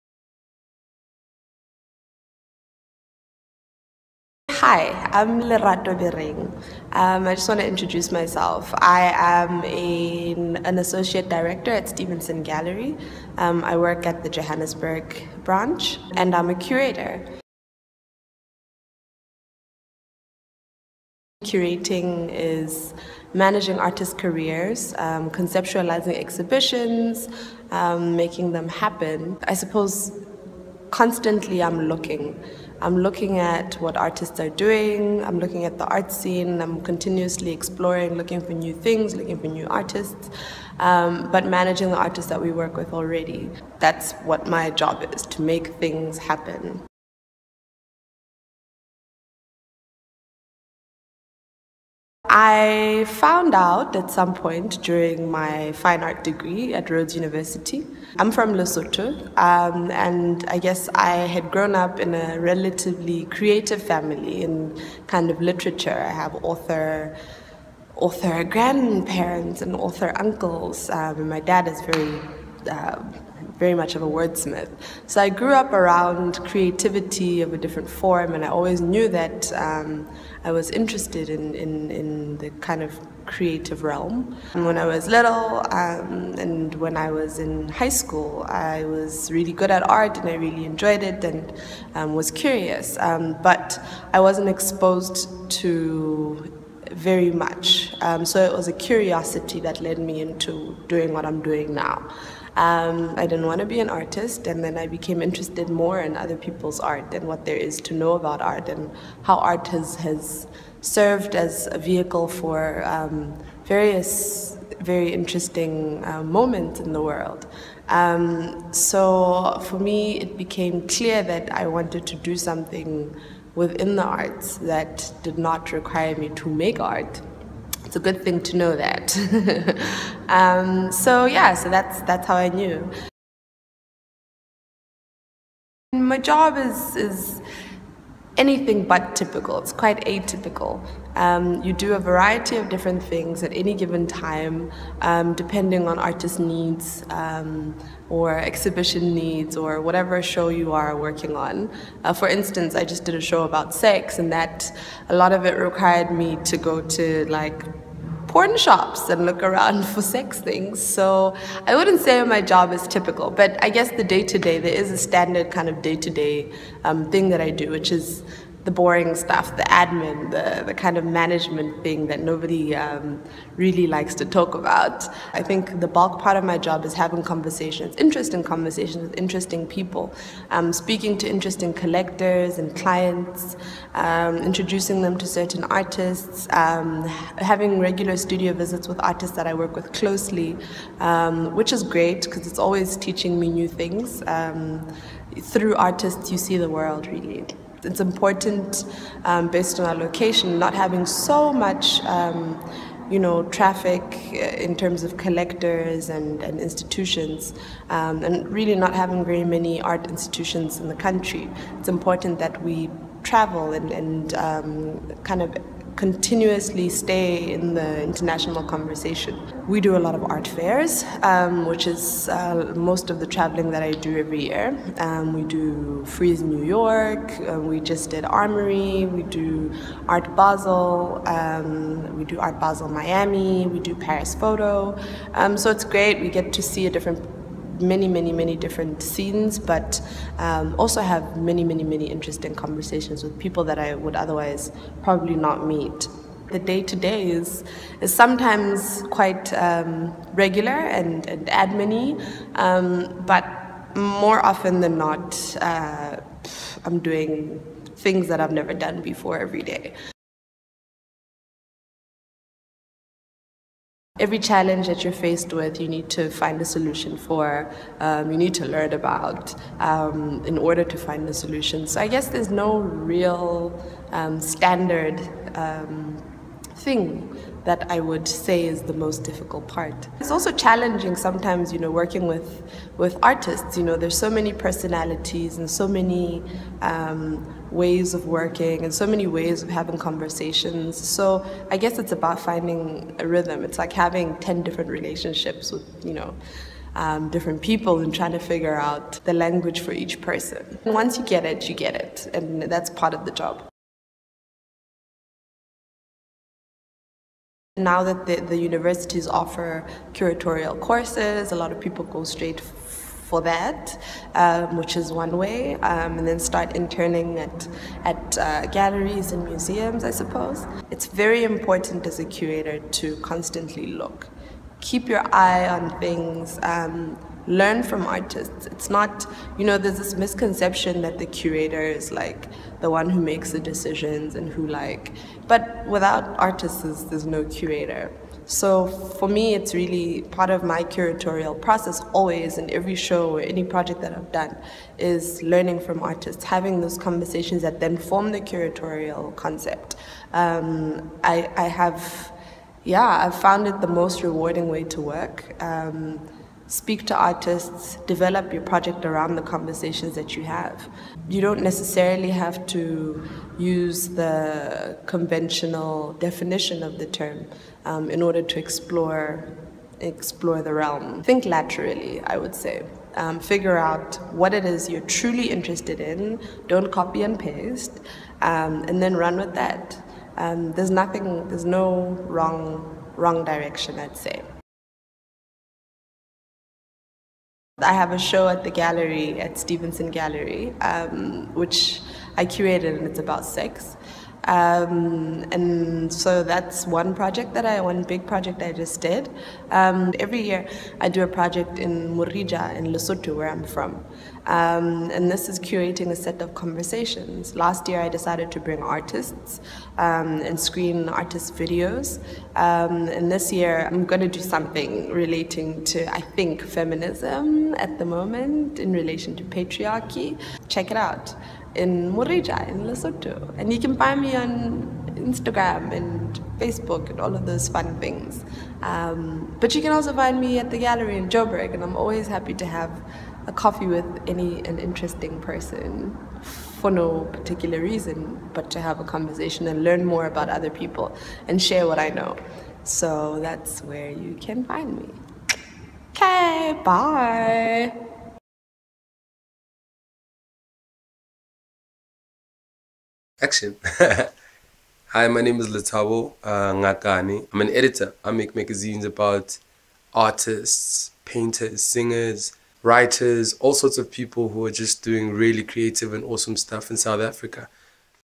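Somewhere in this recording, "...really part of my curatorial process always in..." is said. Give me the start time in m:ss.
5:39.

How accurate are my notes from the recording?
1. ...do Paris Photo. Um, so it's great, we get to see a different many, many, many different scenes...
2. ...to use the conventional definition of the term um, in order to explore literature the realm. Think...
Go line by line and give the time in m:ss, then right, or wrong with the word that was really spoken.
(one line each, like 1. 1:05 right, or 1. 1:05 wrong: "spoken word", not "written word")
1. 3:53 right
2. 6:02 wrong: "explore", not "literature".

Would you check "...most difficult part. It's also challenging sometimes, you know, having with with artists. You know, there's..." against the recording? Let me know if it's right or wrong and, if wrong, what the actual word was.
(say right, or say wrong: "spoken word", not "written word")
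wrong: "working", not "having".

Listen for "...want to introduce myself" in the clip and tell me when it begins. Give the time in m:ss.
0:07.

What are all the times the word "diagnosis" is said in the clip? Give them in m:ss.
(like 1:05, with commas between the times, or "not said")
not said.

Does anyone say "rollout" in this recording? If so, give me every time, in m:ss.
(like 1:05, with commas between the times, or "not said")
not said.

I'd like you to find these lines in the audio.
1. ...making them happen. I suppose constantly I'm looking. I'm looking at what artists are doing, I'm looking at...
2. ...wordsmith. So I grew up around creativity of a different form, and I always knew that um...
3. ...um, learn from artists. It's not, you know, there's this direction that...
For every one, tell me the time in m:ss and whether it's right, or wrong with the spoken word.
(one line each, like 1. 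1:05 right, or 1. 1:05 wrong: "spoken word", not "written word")
1. 0:28 right
2. 1:14 right
3. 5:26 wrong: "misconception", not "direction".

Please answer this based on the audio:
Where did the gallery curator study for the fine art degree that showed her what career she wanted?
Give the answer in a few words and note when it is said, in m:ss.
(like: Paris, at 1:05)
Rhodes University, at 0:56.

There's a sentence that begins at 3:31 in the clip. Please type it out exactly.
It's important that we travel and, and um, kind of continuously stay in the international conversation.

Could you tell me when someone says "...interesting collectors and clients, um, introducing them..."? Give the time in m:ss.
3:01.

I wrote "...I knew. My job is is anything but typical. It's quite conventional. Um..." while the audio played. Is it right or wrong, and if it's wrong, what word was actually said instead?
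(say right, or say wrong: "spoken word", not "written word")
wrong: "atypical", not "conventional".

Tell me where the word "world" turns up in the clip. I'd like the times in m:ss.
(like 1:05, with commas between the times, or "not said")
1:57, 3:16.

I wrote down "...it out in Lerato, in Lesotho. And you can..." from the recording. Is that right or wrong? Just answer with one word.
wrong.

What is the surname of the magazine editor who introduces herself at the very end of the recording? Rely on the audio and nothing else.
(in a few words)
Ngakani.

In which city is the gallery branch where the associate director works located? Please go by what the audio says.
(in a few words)
Johannesburg.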